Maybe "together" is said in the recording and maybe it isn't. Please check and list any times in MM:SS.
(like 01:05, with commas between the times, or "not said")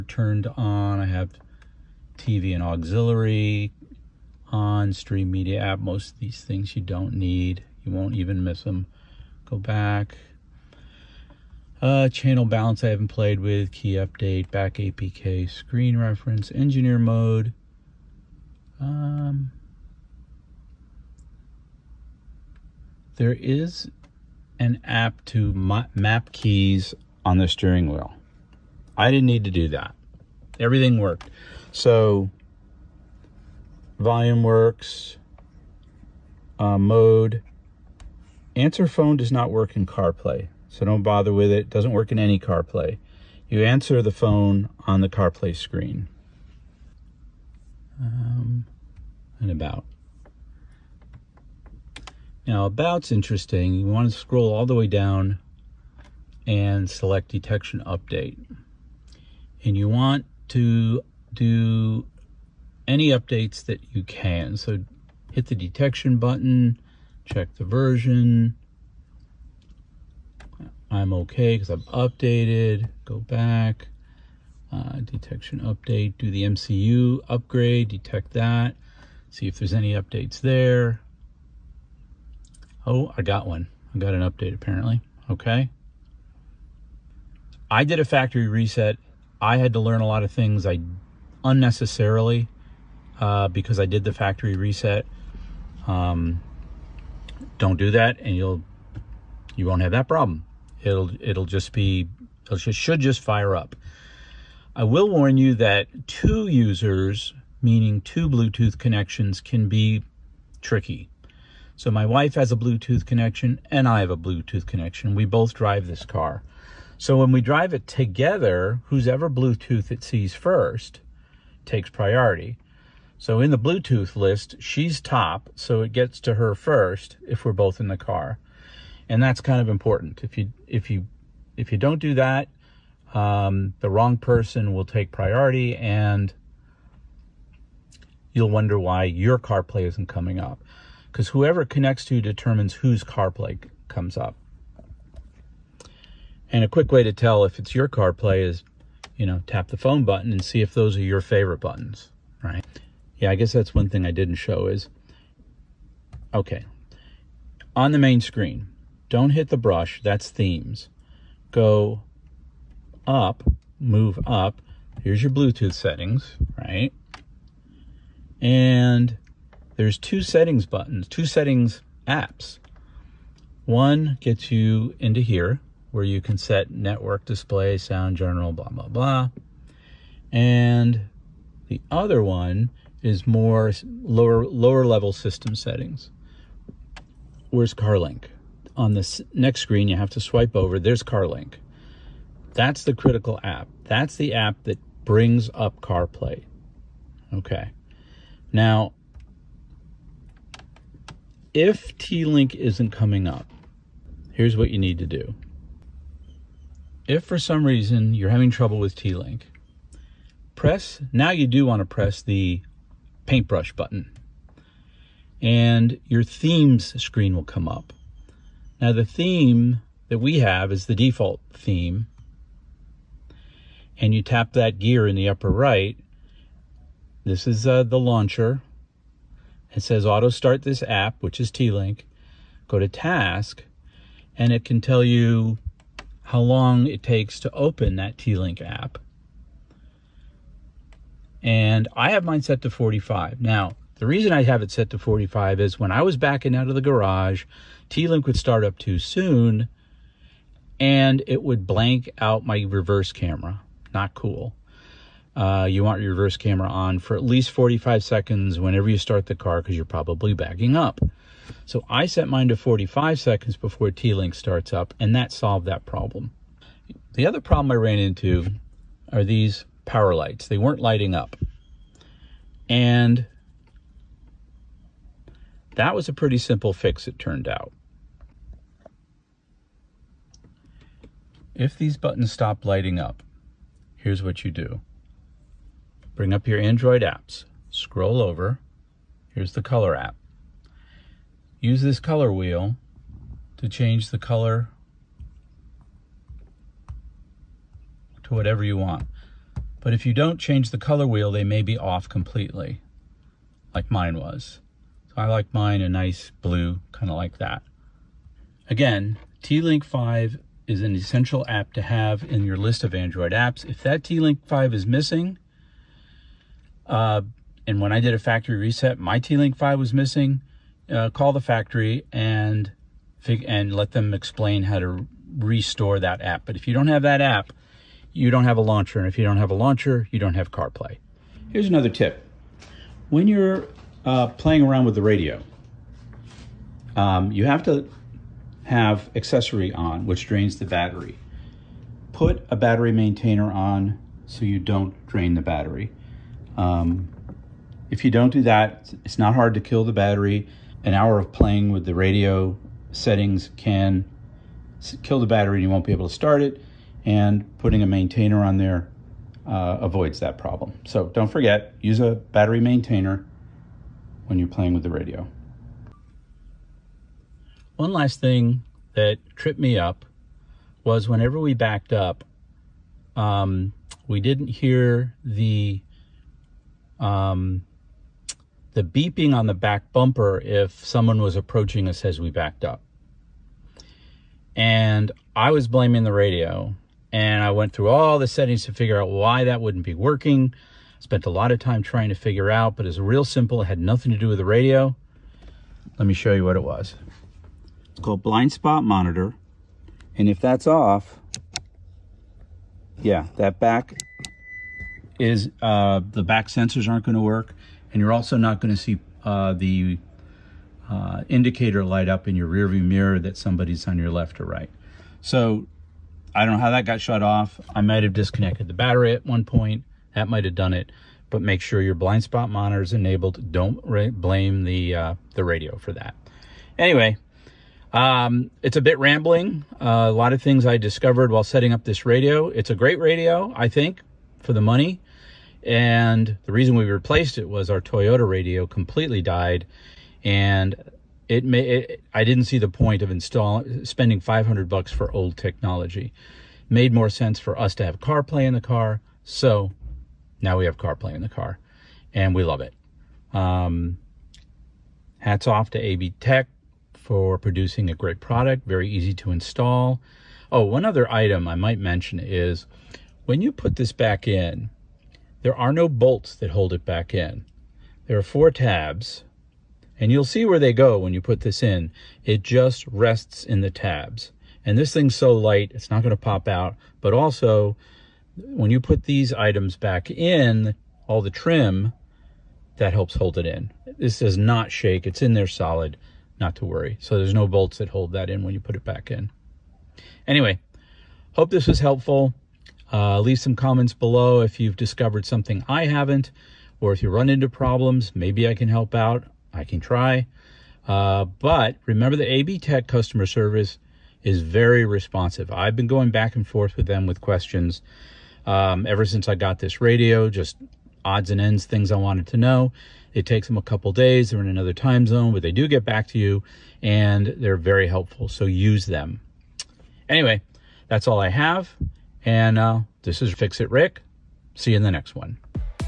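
01:57.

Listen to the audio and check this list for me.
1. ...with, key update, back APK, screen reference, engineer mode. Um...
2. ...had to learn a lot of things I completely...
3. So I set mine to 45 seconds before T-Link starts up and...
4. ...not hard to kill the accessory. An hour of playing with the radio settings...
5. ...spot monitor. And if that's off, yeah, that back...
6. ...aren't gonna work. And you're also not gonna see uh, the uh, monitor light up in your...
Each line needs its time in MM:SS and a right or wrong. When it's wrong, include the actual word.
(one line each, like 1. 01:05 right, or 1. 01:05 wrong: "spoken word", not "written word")
1. 00:13 right
2. 01:29 wrong: "unnecessarily", not "completely"
3. 04:21 right
4. 05:49 wrong: "battery", not "accessory"
5. 06:38 right
6. 06:46 wrong: "indicator", not "monitor".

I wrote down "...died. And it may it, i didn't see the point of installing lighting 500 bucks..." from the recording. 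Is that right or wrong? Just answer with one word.
wrong.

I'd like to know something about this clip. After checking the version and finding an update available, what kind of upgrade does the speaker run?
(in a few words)
MCU upgrade.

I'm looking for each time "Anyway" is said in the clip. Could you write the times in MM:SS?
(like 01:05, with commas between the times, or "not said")
07:06, 08:10, 08:40.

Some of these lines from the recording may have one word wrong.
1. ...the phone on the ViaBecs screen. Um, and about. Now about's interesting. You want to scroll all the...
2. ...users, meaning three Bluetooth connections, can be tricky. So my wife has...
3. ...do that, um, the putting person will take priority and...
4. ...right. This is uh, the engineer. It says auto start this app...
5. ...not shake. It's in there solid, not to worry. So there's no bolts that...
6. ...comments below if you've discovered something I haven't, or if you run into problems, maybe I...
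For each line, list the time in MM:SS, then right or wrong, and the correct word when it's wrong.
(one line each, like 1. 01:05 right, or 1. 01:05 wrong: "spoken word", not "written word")
1. 00:44 wrong: "CarPlay", not "ViaBecs"
2. 01:46 wrong: "two", not "three"
3. 02:11 wrong: "wrong", not "putting"
4. 03:45 wrong: "launcher", not "engineer"
5. 08:04 right
6. 08:13 right.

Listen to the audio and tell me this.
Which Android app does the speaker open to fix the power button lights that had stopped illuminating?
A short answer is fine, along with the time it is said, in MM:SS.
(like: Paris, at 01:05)
Color app, at 04:49.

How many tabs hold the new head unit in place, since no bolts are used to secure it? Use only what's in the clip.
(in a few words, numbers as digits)
4.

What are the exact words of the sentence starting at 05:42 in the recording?
Put a battery maintainer on so you don't drain the battery.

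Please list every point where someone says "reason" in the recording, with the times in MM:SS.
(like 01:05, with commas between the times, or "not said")
03:27, 04:04, 07:16.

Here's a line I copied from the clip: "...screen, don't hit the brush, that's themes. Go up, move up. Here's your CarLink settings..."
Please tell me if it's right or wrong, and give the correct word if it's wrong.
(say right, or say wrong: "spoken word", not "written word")
wrong: "Bluetooth", not "CarLink".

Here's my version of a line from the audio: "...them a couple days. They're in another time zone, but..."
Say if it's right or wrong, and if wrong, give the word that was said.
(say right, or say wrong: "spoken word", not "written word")
right.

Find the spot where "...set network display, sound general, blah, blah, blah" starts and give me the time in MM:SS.
02:56.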